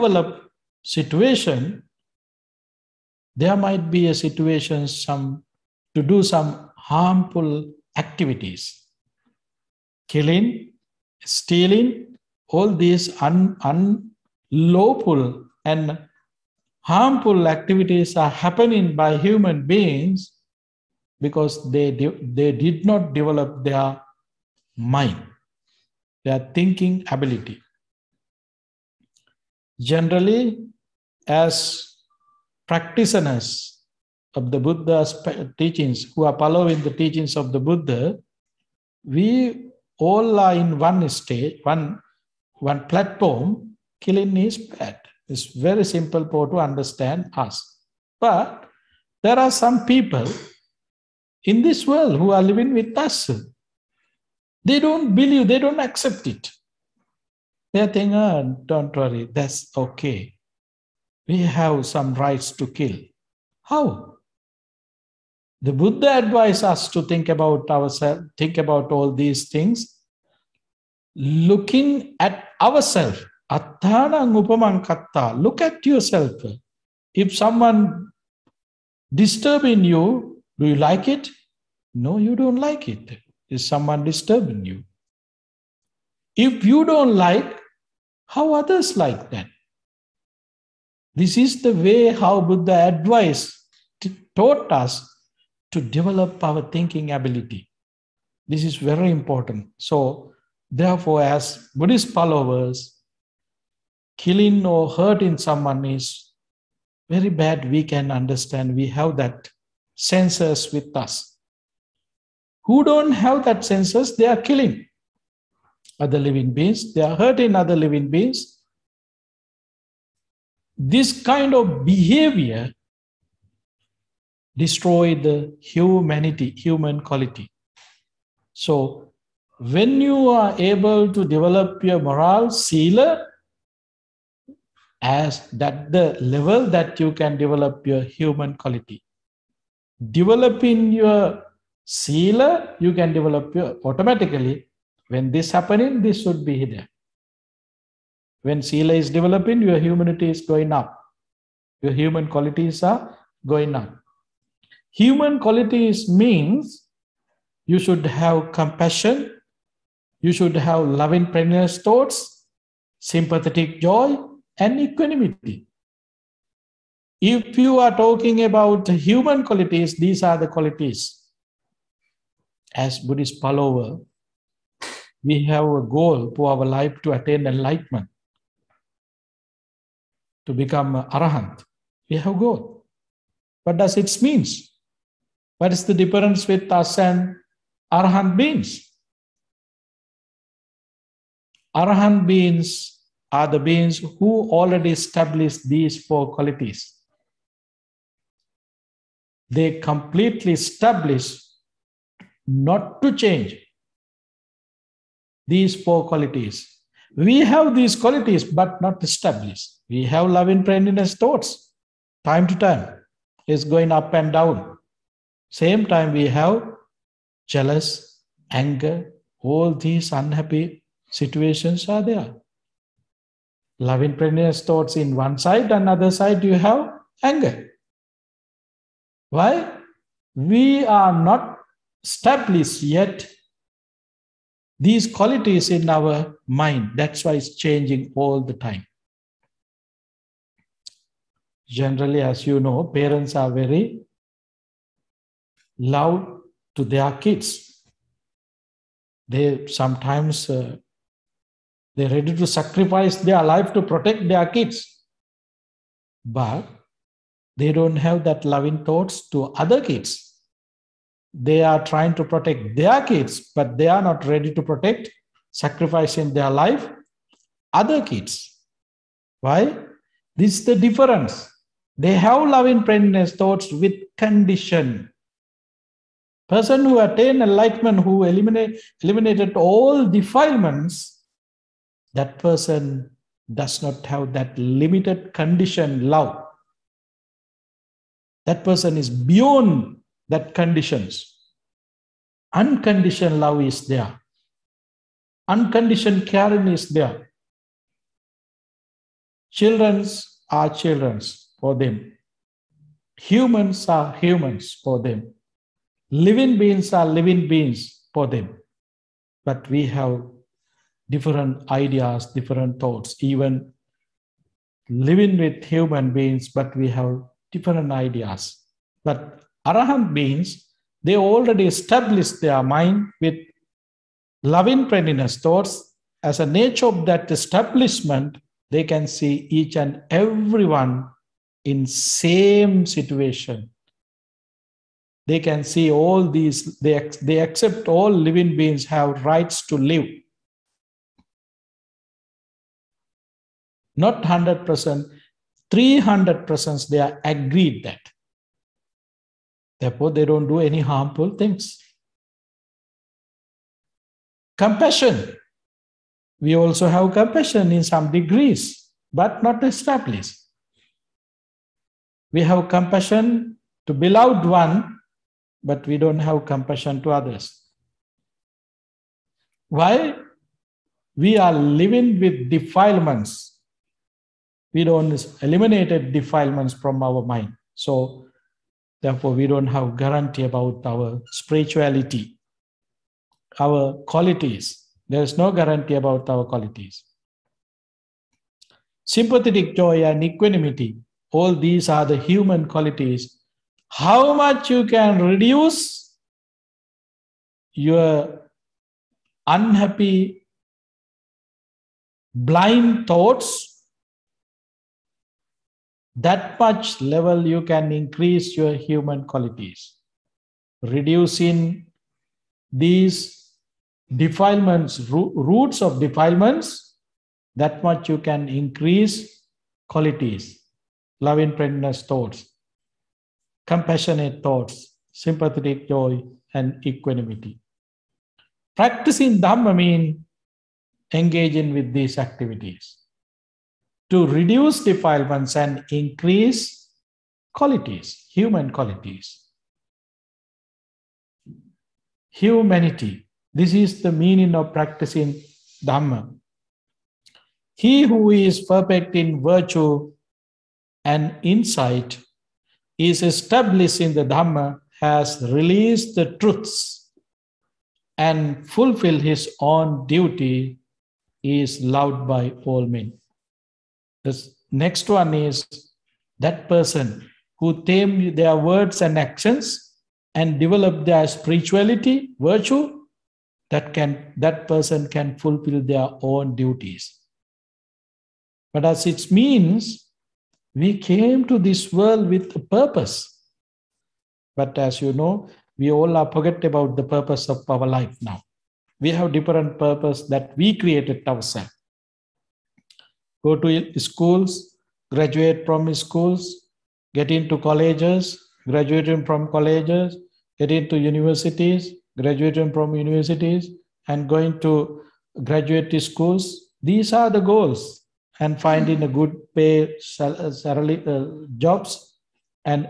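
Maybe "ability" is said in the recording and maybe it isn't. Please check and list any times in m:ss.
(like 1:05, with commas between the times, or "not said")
0:27, 1:37.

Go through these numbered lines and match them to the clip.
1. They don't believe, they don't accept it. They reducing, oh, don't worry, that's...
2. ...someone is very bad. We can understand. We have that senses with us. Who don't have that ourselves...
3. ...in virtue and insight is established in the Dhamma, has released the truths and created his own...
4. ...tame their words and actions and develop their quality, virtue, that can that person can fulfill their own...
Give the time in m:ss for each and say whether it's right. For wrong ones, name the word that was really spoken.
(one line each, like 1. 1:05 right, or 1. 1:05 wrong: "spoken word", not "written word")
1. 0:54 wrong: "thinking", not "reducing"
2. 1:45 wrong: "senses", not "ourselves"
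3. 7:29 wrong: "fulfilled", not "created"
4. 7:47 wrong: "spirituality", not "quality".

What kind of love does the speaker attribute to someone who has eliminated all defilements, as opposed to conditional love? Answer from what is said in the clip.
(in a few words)
Unconditioned love.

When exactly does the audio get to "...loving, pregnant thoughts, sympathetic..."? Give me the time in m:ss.
2:40.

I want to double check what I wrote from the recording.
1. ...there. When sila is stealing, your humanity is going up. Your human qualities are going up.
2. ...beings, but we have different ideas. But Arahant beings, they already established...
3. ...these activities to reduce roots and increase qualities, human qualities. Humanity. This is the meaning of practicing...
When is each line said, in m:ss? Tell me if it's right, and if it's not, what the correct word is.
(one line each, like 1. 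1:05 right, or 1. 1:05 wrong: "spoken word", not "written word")
1. 2:26 wrong: "developing", not "stealing"
2. 5:16 right
3. 7:11 wrong: "defilements", not "roots".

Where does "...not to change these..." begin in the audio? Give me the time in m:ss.
3:22.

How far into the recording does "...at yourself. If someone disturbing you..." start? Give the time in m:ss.
1:15.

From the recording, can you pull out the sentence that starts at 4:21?
They are trying to protect their kids, but they are not ready to protect, sacrificing their life, other kids.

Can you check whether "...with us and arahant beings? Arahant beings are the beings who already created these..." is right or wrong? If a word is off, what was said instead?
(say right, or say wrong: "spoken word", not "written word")
wrong: "established", not "created".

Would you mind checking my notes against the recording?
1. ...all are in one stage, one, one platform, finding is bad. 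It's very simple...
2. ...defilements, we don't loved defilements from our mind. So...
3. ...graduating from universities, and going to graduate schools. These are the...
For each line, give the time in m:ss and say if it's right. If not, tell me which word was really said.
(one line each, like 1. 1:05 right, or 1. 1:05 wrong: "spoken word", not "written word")
1. 0:39 wrong: "killing", not "finding"
2. 6:12 wrong: "eliminated", not "loved"
3. 8:22 right.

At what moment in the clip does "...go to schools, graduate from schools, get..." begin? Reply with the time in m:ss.
8:13.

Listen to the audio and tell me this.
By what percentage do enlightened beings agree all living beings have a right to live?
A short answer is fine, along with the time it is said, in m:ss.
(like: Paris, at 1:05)
300%, at 5:45.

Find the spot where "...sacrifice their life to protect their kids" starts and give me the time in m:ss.
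4:12.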